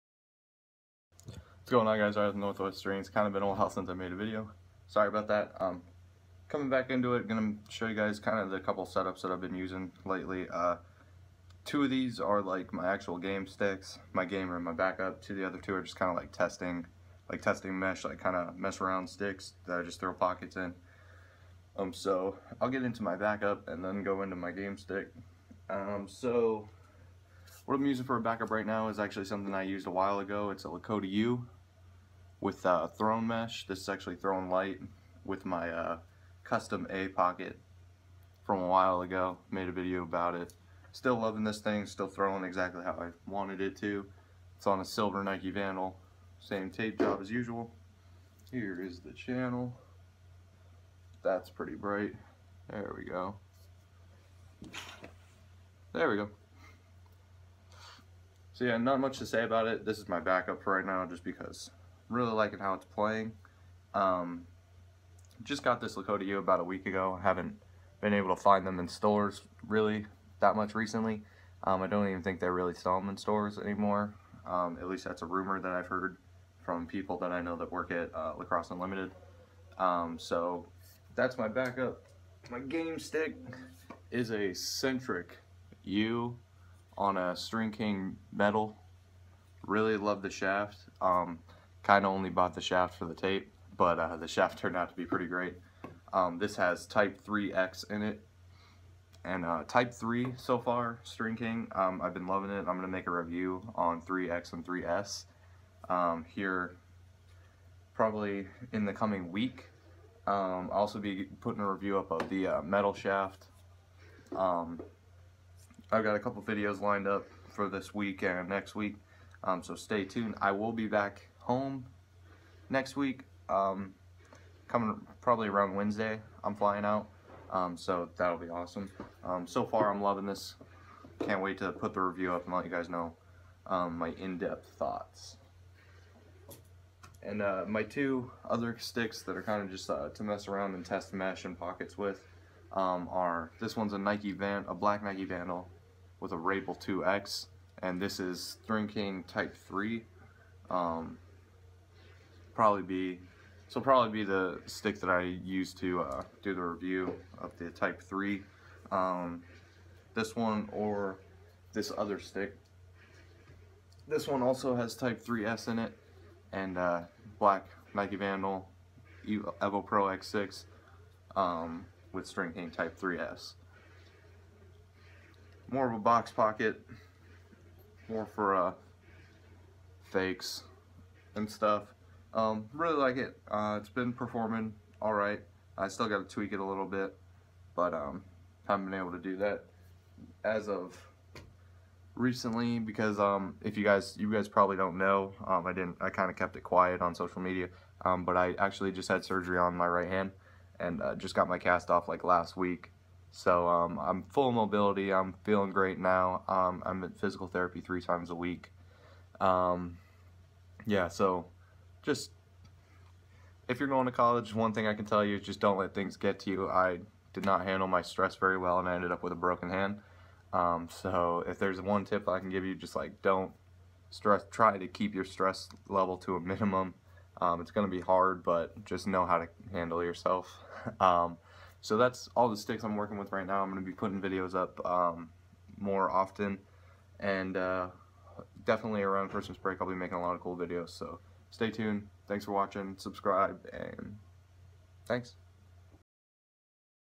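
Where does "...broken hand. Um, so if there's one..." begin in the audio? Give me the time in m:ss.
3:39.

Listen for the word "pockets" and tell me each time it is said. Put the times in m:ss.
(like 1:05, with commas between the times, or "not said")
0:20, 0:37, 2:21, 2:56.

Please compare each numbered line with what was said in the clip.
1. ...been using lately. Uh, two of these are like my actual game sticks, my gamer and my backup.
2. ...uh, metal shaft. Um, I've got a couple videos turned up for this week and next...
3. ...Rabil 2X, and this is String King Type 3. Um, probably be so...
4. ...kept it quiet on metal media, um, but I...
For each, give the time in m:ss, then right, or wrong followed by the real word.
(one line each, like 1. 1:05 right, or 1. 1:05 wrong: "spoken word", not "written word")
1. 0:09 right
2. 1:52 wrong: "lined", not "turned"
3. 2:26 right
4. 3:16 wrong: "social", not "metal".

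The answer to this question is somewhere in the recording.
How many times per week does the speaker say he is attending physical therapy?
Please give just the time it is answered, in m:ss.
3:27.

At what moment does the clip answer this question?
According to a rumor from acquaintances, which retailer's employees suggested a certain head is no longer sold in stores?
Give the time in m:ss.
1:18.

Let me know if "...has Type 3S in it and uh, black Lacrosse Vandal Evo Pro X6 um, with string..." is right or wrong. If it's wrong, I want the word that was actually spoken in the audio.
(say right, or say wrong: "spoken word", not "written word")
wrong: "Nike", not "Lacrosse".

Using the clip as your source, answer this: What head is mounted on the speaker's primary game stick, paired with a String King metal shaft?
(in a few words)
Centric U.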